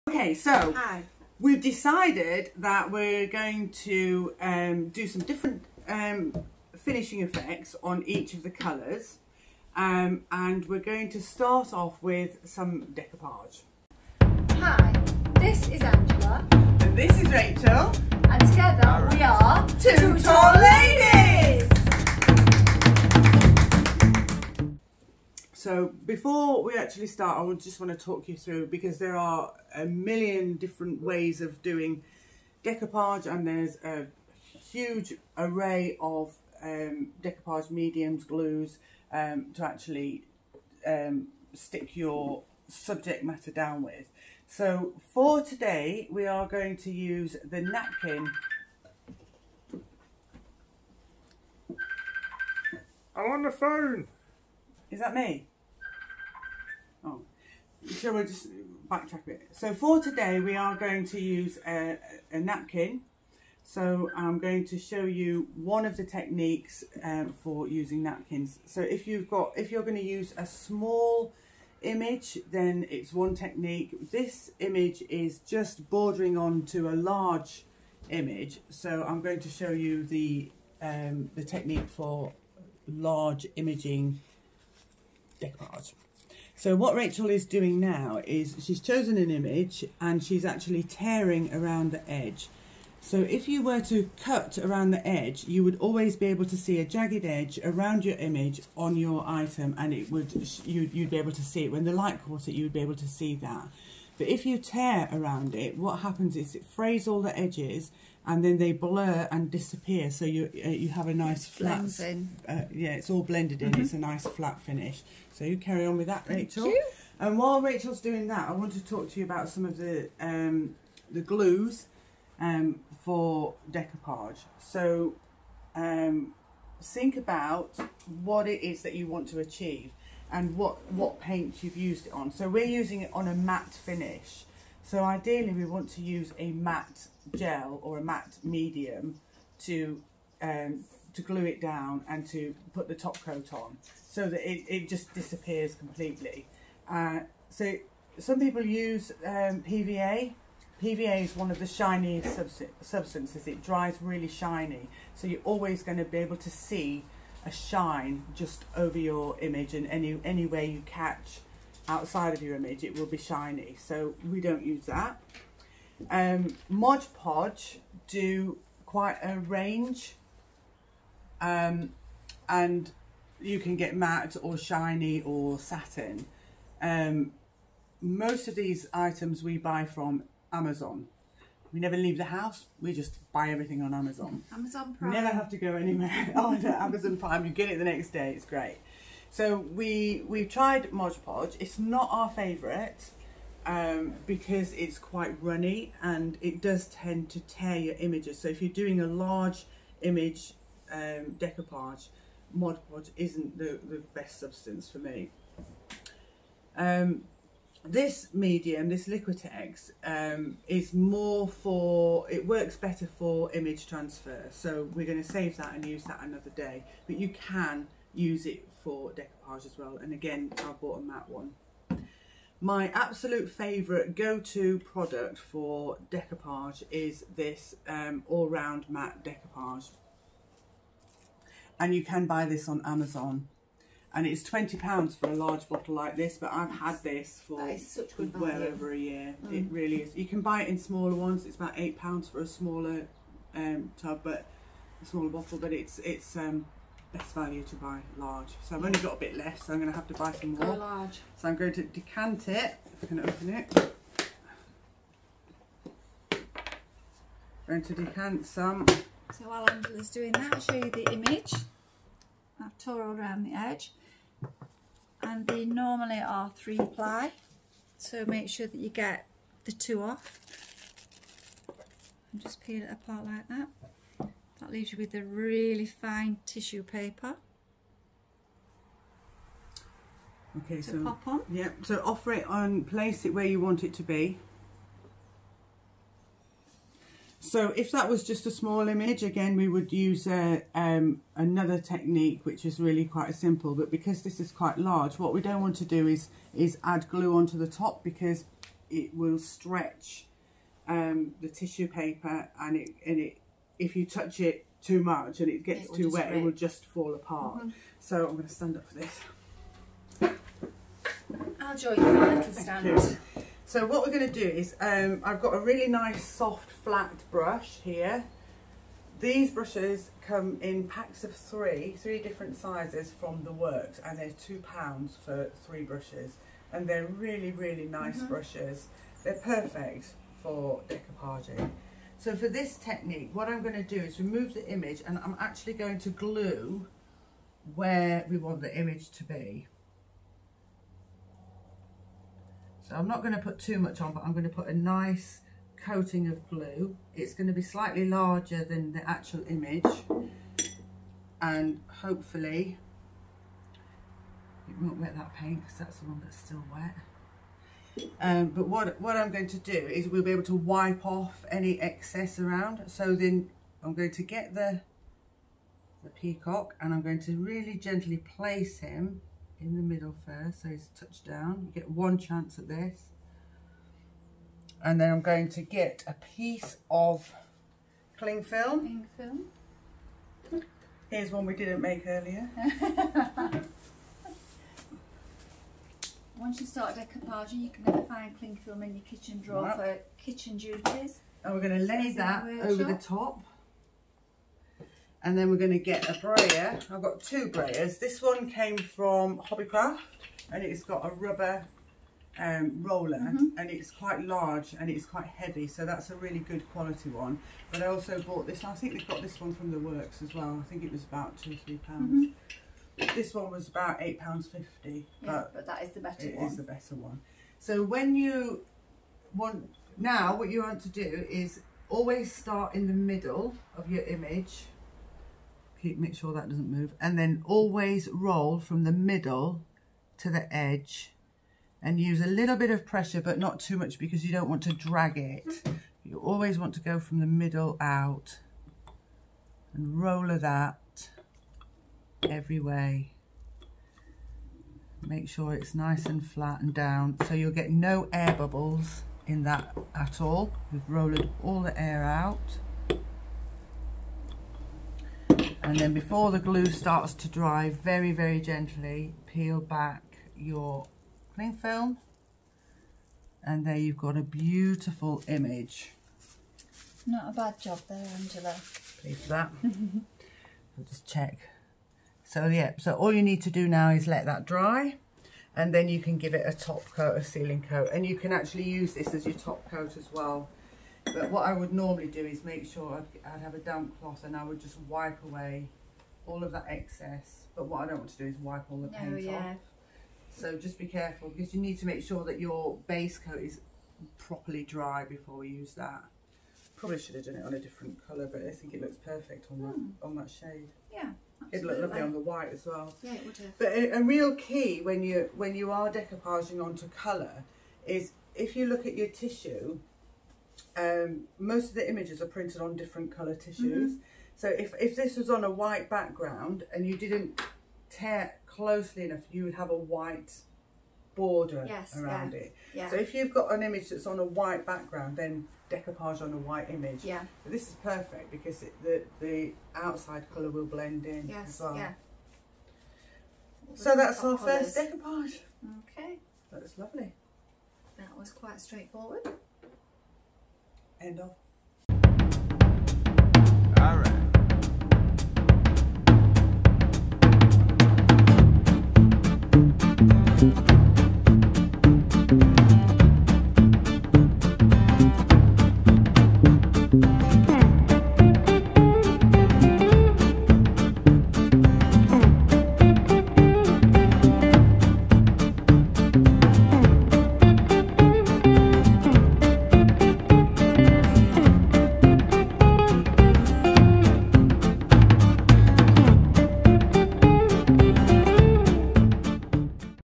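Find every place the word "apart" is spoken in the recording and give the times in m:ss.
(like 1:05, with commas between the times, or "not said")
4:32, 5:07.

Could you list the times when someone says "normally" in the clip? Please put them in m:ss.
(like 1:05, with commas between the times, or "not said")
4:25, 8:01.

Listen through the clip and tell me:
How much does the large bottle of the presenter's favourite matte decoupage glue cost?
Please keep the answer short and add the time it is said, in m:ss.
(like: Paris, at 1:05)
£20, at 3:54.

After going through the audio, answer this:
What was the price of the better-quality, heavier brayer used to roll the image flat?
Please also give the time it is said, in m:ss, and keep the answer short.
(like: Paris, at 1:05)
£8.50, at 6:53.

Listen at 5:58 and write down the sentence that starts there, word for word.
Um, but what, what I'm going to do is we'll be able to wipe off any excess around.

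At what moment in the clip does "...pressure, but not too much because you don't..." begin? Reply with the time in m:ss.
7:12.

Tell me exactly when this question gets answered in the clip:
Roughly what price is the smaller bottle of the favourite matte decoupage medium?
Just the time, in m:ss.
4:01.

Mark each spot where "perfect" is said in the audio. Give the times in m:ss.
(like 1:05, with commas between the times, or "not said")
5:29, 8:18, 8:47.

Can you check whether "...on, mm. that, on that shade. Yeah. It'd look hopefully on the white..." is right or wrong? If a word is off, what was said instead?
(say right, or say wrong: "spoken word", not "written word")
wrong: "lovely", not "hopefully".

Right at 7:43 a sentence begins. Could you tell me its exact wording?
And there you've got a beautiful image.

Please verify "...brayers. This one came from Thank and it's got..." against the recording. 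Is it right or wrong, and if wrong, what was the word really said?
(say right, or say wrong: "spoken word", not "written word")
wrong: "Hobbycraft", not "Thank".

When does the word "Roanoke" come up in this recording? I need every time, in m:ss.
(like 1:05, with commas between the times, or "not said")
not said.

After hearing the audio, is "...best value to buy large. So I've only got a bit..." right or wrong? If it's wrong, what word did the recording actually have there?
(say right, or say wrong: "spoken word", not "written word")
right.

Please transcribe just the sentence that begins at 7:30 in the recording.
We've rolled all the air out.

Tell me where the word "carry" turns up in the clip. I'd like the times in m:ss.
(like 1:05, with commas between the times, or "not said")
1:55.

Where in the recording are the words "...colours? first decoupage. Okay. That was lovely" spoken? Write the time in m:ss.
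8:54.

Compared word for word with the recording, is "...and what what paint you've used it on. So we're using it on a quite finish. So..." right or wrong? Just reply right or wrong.
wrong.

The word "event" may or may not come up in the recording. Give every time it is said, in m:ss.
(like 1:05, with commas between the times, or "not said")
not said.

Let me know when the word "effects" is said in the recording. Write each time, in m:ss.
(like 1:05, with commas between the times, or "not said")
0:07.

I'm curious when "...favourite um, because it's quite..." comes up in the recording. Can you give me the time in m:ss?
3:12.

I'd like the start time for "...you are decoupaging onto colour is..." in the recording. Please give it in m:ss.
8:25.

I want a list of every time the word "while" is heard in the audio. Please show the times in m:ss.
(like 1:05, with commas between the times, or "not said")
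1:57, 4:19.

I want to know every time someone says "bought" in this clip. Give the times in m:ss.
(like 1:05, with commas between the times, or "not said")
3:40, 6:48.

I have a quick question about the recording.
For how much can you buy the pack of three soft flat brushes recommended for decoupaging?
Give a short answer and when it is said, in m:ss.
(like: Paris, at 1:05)
2 pounds, at 5:24.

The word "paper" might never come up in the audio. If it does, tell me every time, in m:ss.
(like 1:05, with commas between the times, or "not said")
4:36, 5:01.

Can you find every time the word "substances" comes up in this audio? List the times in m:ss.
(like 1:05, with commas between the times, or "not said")
2:32, 3:24.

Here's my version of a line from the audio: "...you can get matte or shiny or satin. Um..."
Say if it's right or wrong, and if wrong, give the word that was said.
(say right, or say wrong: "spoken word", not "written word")
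right.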